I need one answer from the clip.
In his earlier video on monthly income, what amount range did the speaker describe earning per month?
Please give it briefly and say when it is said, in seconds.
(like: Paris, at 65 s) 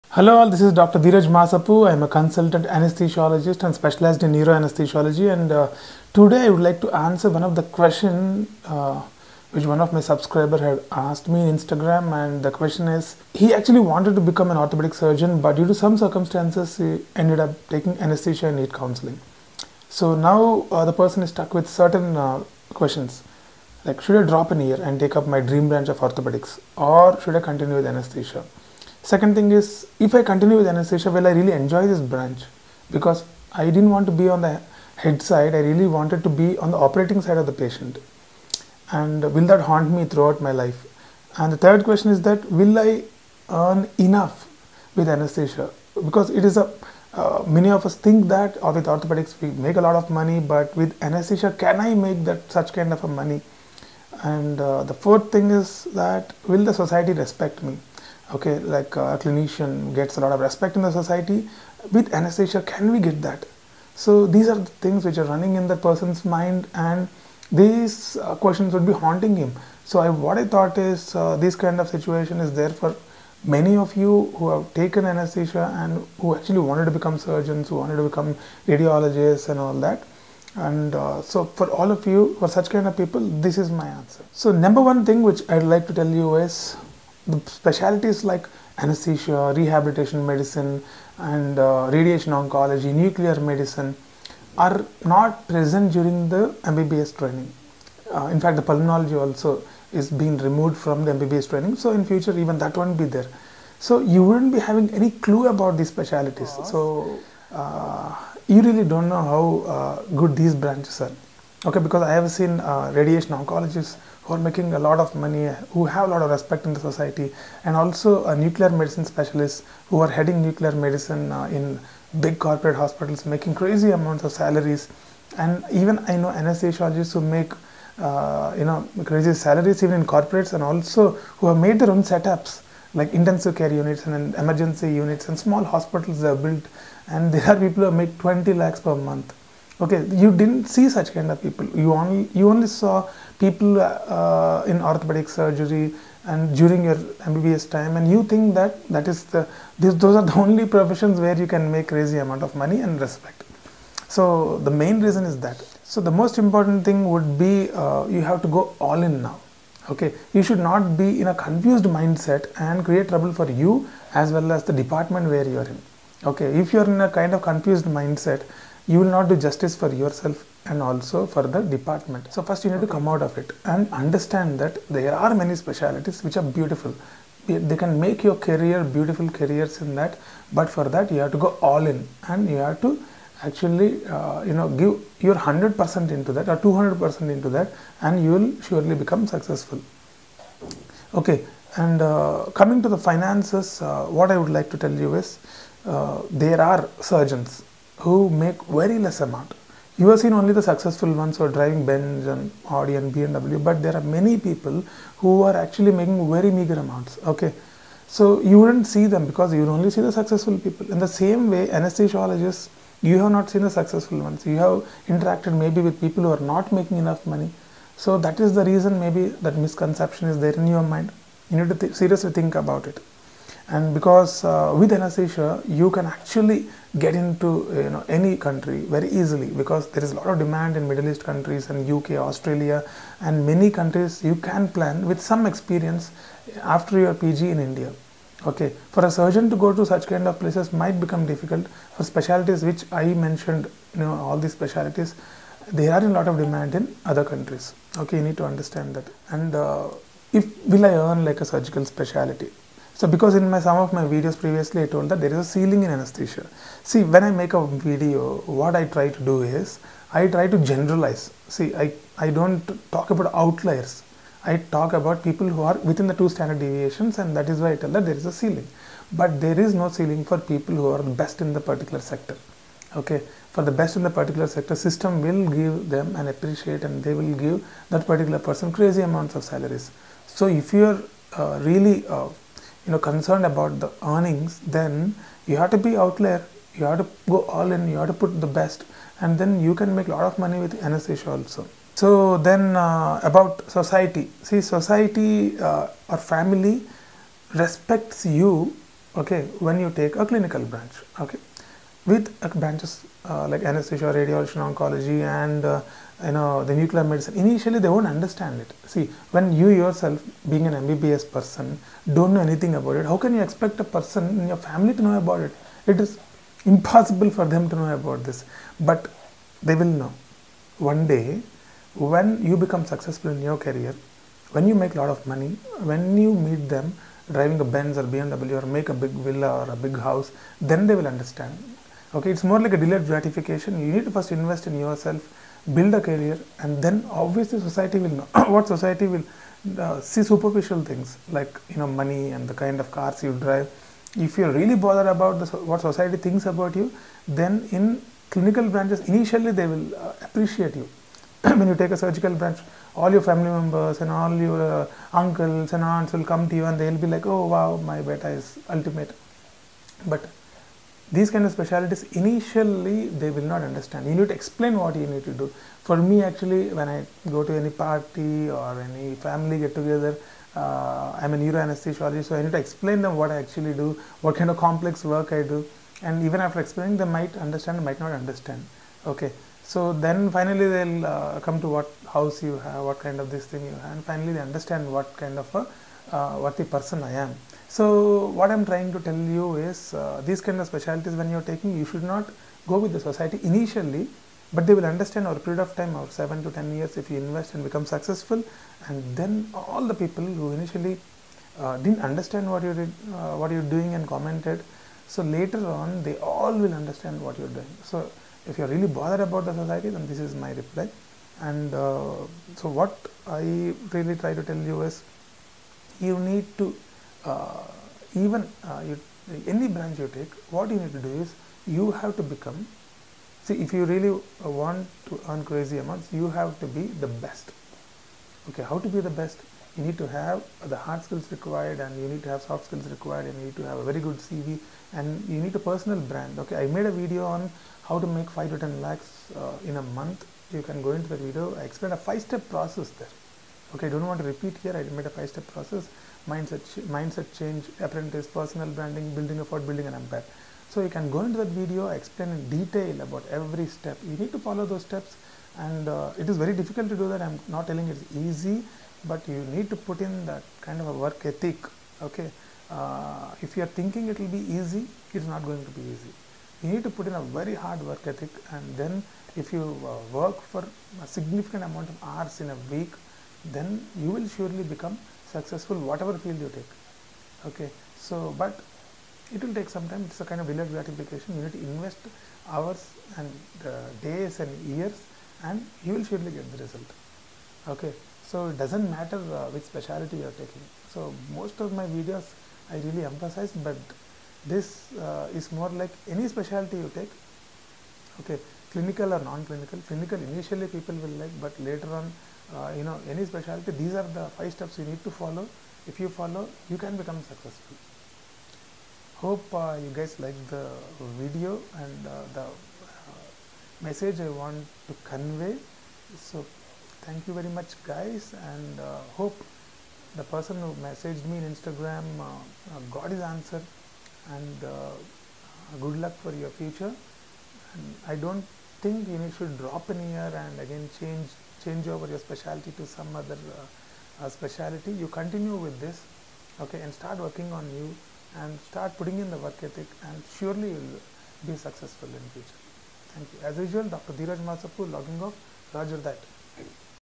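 5 to 10 lakhs, at 438 s.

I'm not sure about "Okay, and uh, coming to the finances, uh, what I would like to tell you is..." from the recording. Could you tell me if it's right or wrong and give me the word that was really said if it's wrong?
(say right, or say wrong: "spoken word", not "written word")
right.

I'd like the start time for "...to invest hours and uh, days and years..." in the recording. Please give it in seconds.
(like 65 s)
481 s.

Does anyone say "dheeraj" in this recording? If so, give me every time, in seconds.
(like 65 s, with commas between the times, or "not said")
0 s, 544 s.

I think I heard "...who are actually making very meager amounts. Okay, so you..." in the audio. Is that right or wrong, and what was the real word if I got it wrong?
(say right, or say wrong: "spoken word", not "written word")
right.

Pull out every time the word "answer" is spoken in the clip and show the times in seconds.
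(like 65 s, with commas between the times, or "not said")
6 s, 83 s, 523 s.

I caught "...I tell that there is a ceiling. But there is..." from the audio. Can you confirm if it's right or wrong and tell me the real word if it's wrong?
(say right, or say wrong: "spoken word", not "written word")
right.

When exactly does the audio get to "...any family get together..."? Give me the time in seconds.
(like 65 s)
368 s.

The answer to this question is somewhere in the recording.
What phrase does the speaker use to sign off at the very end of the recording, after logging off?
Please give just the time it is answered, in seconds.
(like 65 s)
545 s.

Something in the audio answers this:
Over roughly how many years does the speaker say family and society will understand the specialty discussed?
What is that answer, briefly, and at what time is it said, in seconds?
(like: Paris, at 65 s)
7 to 10 years, at 396 s.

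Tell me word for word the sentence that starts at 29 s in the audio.
Second thing is, if I continue with anesthesia, will I really enjoy this branch?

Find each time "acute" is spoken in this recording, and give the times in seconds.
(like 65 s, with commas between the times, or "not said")
not said.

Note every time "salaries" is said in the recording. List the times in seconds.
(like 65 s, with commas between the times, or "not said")
124 s, 129 s, 279 s.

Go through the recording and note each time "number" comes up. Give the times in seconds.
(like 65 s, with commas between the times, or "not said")
84 s.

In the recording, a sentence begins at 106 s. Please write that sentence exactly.
So uh, you really don't know how uh, good these branches are.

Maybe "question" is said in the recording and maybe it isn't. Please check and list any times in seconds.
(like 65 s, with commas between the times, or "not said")
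7 s, 12 s, 22 s, 41 s, 68 s.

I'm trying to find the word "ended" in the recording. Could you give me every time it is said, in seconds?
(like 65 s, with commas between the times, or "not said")
17 s.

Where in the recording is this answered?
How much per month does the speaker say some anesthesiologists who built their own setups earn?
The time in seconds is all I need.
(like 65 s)
138 s.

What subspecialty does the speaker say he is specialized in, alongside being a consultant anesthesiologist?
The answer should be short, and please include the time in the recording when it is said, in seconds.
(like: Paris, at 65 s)
Neuroanesthesiology, at 4 s.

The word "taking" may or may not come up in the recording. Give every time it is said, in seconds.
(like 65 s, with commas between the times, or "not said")
17 s, 391 s, 490 s.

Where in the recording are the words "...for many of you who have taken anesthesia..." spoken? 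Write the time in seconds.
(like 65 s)
72 s.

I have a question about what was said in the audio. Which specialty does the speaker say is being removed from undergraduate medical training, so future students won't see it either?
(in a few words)
Pulmonology.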